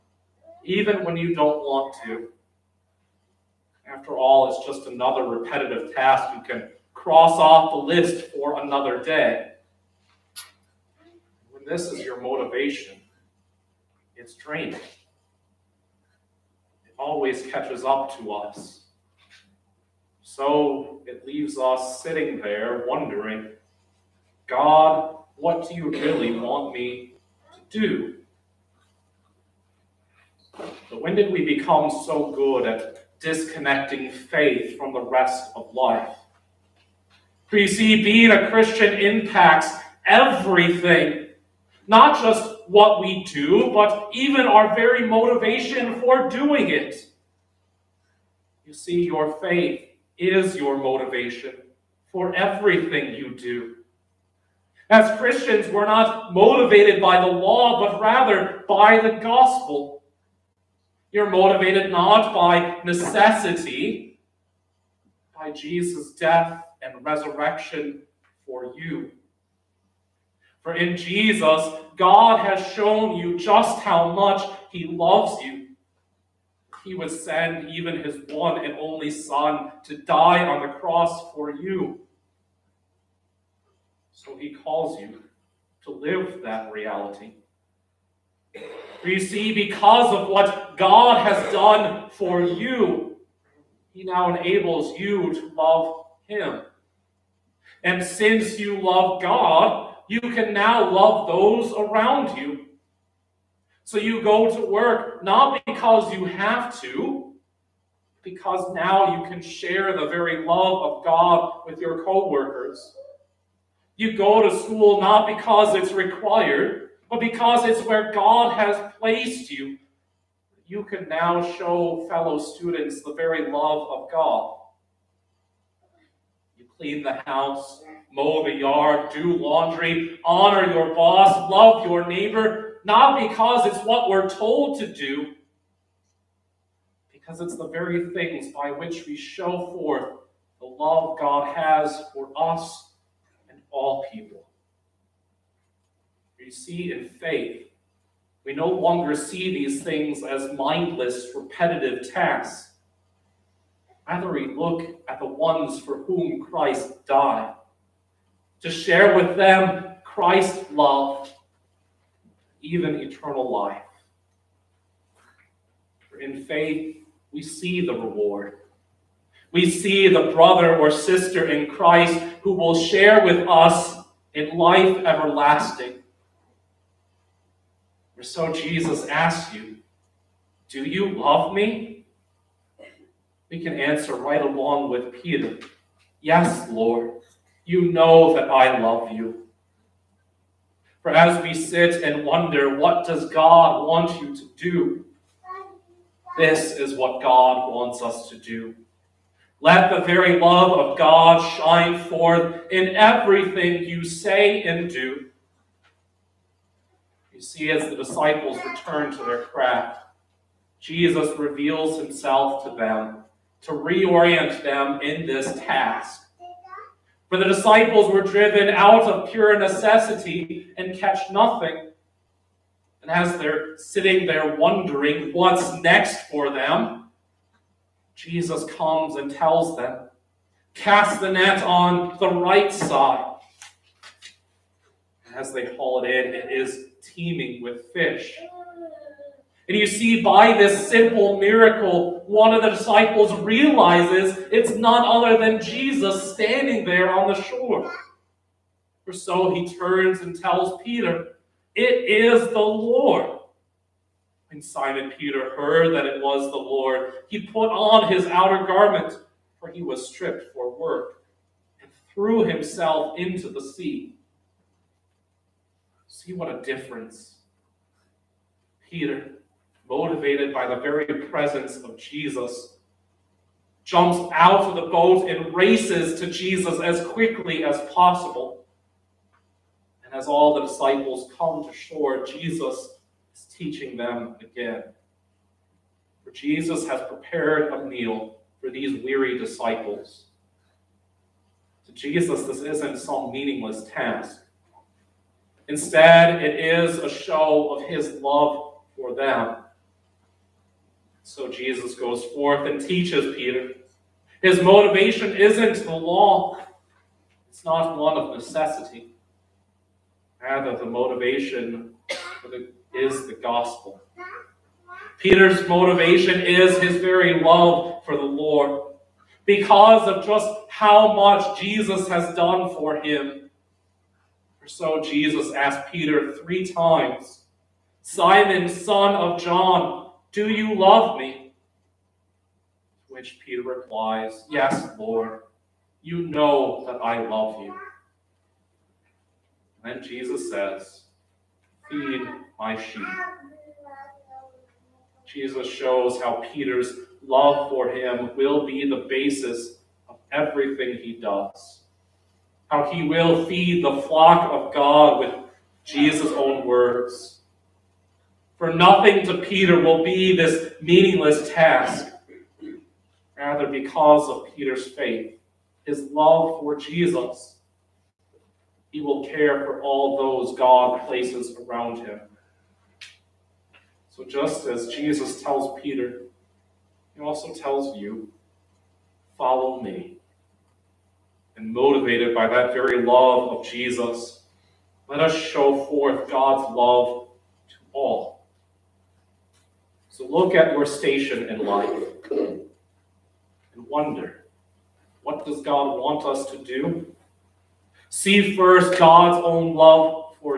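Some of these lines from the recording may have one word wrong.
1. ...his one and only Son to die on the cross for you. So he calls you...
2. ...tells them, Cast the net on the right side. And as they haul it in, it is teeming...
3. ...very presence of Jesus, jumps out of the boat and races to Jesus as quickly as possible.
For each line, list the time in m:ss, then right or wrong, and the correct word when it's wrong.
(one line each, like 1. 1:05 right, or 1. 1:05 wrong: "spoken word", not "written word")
1. 1:18 right
2. 3:49 right
3. 4:30 right.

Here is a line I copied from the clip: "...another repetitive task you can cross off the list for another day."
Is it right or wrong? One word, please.
right.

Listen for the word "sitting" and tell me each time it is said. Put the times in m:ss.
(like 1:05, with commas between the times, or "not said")
0:22, 3:43.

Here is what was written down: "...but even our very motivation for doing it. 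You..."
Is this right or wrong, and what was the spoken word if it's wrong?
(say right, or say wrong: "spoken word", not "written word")
right.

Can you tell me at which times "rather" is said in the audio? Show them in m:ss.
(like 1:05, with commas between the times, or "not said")
0:58, 2:34, 5:10, 6:03.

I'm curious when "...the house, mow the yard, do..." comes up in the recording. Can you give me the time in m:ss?
2:07.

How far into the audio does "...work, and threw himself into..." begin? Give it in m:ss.
4:20.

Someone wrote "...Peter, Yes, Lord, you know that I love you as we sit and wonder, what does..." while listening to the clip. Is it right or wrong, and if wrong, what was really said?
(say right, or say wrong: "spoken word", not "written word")
right.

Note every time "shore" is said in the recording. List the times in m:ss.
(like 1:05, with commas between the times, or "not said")
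4:07, 4:41.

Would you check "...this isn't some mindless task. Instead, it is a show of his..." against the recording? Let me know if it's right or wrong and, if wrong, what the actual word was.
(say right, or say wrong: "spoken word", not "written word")
wrong: "meaningless", not "mindless".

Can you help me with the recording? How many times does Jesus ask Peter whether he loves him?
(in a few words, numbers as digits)
3.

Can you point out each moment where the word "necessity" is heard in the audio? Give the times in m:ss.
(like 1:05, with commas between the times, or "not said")
1:02, 3:39, 5:08.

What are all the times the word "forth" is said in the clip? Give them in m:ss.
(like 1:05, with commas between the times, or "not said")
2:19, 3:22, 5:02, 6:25.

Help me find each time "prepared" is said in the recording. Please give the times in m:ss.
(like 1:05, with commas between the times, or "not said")
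4:47.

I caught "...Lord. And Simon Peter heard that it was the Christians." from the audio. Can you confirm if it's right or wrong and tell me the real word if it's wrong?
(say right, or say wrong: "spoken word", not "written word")
wrong: "Lord", not "Christians".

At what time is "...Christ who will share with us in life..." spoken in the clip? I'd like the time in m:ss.
2:51.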